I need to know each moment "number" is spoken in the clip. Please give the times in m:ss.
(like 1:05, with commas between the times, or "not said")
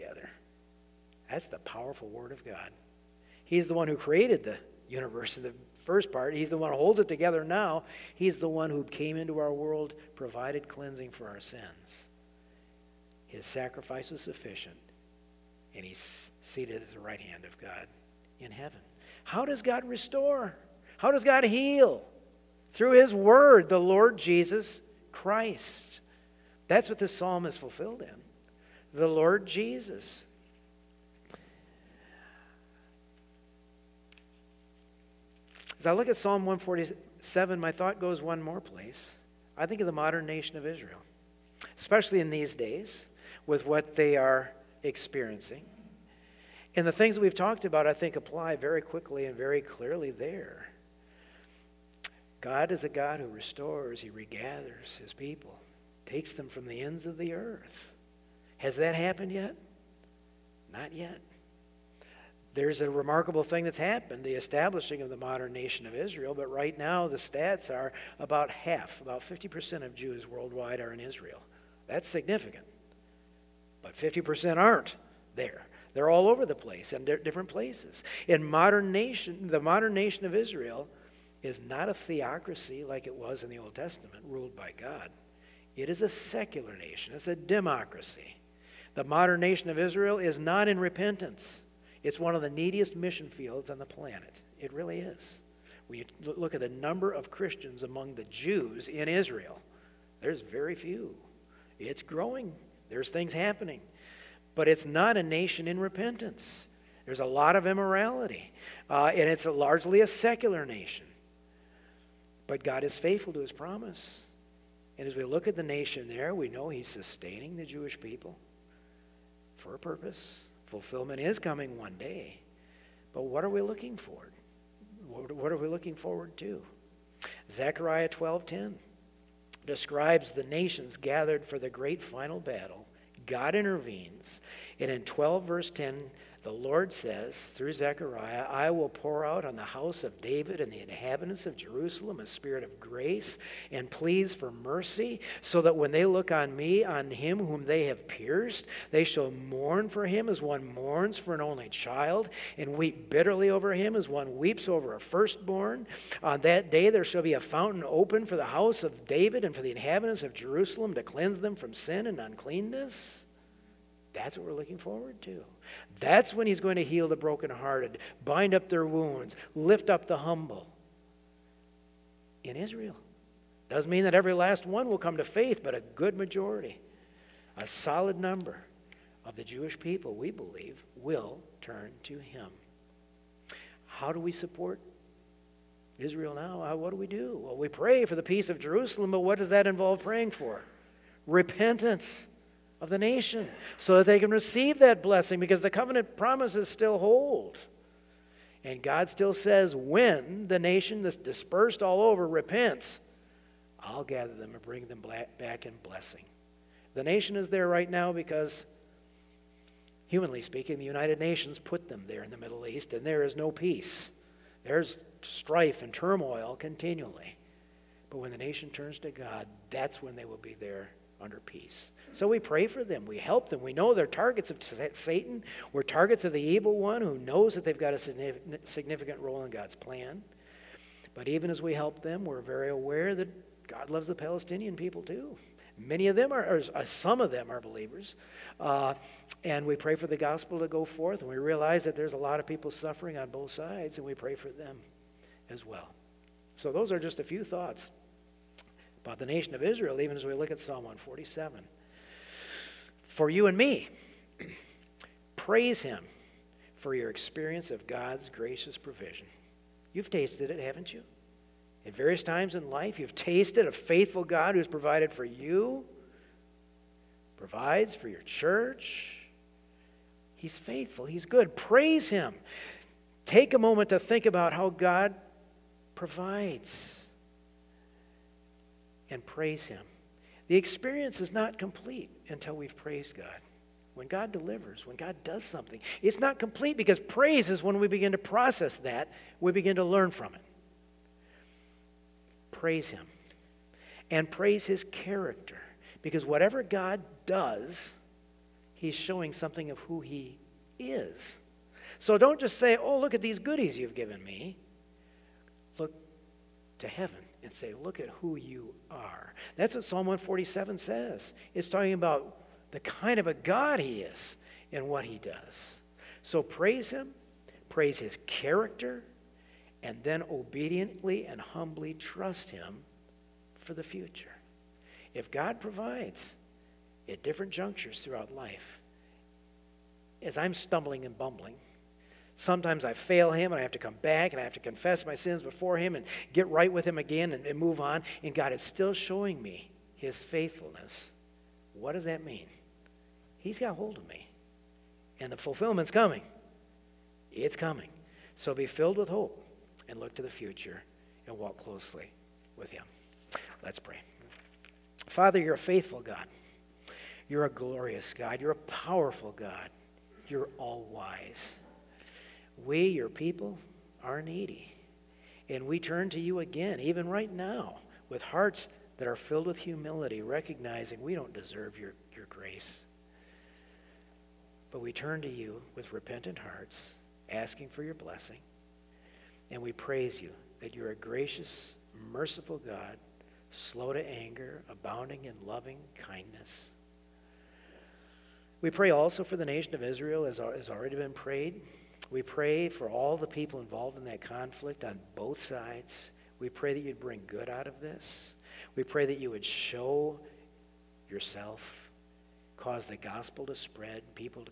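1:36, 2:58.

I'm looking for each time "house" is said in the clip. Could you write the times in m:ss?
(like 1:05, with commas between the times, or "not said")
2:19, 2:38.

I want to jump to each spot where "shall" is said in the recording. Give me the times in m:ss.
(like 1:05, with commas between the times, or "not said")
2:29, 2:37.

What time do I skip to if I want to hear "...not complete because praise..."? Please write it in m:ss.
4:46.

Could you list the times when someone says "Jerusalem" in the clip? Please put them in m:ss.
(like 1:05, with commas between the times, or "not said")
2:21, 2:40, 3:08.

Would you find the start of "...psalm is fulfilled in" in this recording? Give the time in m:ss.
0:27.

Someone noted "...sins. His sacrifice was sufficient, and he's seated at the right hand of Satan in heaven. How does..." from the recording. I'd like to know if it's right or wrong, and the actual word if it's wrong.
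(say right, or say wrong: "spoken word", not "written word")
wrong: "God", not "Satan".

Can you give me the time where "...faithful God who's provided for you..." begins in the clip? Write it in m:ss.
4:23.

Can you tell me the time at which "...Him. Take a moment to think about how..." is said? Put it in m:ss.
4:32.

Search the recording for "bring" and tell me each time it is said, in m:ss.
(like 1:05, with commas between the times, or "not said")
3:24, 6:36.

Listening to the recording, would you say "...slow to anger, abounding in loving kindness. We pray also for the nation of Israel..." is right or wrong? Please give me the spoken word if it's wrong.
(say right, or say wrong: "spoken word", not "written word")
right.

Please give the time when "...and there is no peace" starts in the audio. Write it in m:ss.
3:32.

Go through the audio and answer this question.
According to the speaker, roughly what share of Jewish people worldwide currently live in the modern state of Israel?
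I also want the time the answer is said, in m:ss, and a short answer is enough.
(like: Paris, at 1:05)
50%, at 1:08.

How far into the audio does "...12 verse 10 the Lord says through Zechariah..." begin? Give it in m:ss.
2:15.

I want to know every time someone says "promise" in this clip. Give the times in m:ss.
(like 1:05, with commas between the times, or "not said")
1:53, 3:16.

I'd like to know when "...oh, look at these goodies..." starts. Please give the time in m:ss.
5:02.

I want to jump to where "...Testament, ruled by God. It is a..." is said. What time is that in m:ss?
1:23.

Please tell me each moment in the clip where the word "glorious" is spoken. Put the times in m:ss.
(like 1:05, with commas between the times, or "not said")
5:57.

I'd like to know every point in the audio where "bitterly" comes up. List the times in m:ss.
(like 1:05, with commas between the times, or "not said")
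2:33.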